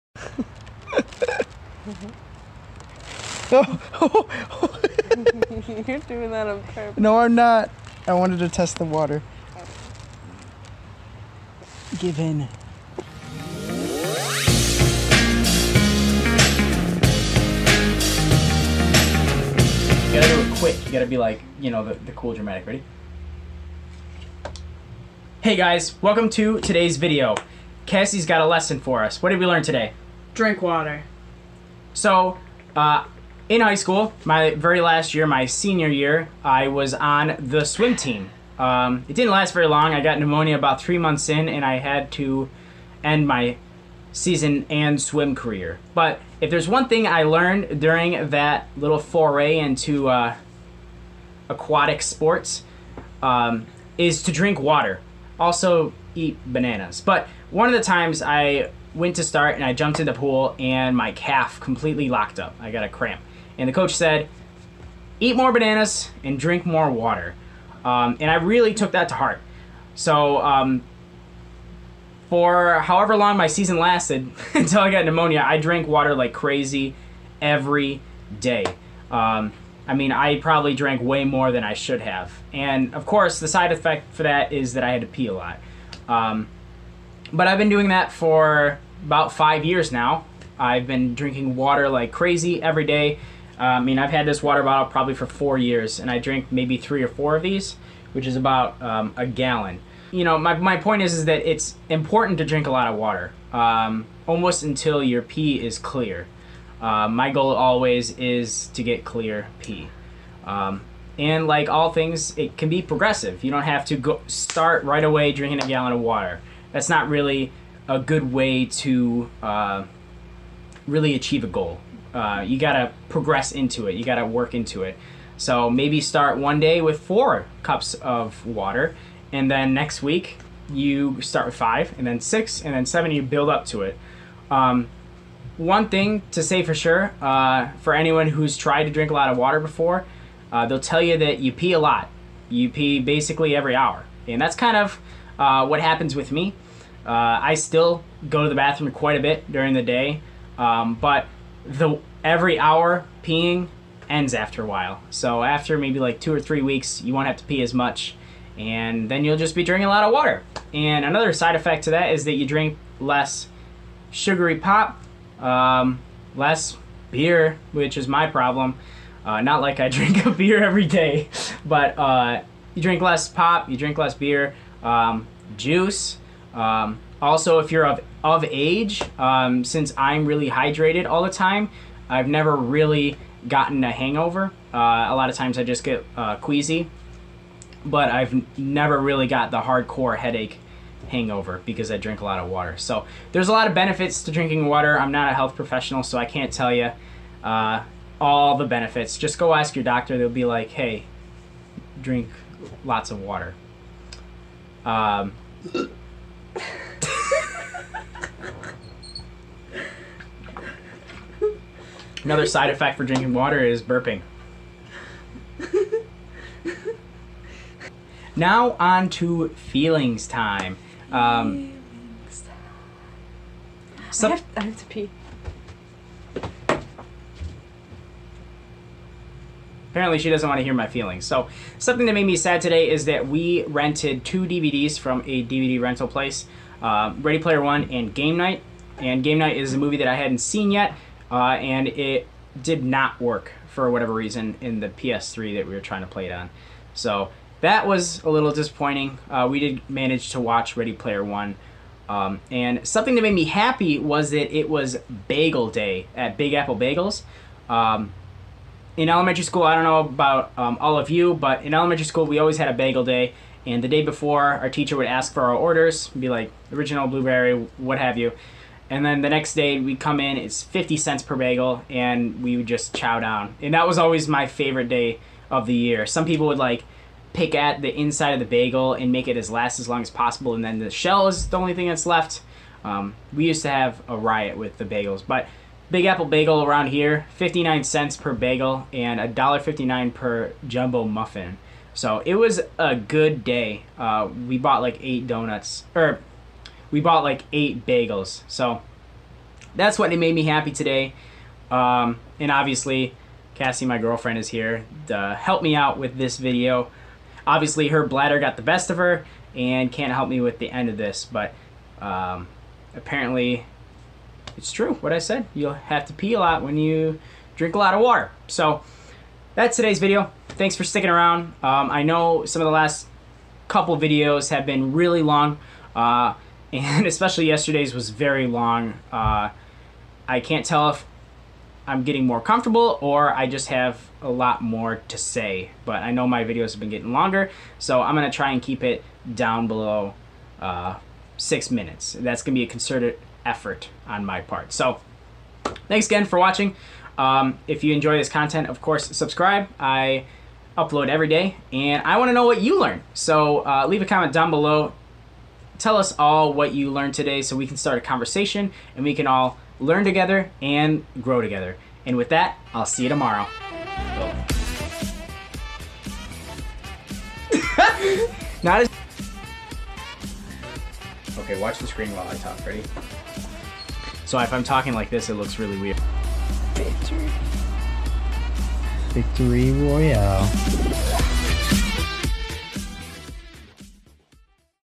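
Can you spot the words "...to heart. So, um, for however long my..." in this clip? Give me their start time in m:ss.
1:09.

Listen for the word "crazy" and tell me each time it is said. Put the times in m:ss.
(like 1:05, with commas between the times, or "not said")
1:16, 1:32.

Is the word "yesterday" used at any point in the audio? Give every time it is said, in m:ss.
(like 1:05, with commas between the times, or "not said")
5:27.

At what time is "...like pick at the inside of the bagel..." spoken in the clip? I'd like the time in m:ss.
4:36.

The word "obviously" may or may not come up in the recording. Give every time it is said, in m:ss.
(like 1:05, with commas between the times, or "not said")
5:02, 5:07.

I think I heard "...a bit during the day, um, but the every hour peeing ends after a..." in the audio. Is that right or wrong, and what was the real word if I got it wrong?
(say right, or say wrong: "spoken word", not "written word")
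right.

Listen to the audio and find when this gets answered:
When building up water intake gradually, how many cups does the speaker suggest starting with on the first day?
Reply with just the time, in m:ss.
2:06.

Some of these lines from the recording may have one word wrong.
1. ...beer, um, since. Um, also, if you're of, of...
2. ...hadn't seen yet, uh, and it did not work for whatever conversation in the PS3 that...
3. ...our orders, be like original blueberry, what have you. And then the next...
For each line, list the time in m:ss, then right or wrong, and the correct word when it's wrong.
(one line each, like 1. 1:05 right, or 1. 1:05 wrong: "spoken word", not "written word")
1. 2:54 wrong: "juice", not "since"
2. 4:00 wrong: "reason", not "conversation"
3. 4:25 right.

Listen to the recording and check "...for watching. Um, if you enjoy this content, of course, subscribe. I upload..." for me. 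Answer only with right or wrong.
right.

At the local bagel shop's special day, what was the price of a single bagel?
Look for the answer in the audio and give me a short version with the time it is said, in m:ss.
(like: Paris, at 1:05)
59 cents, at 4:47.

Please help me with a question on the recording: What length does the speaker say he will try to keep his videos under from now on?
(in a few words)
6 minutes.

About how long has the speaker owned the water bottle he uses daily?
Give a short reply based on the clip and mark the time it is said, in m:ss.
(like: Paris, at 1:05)
4 years, at 1:35.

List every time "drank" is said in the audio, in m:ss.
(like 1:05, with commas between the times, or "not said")
1:15, 1:20.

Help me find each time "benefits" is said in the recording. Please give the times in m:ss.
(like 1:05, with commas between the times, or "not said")
3:13, 3:18.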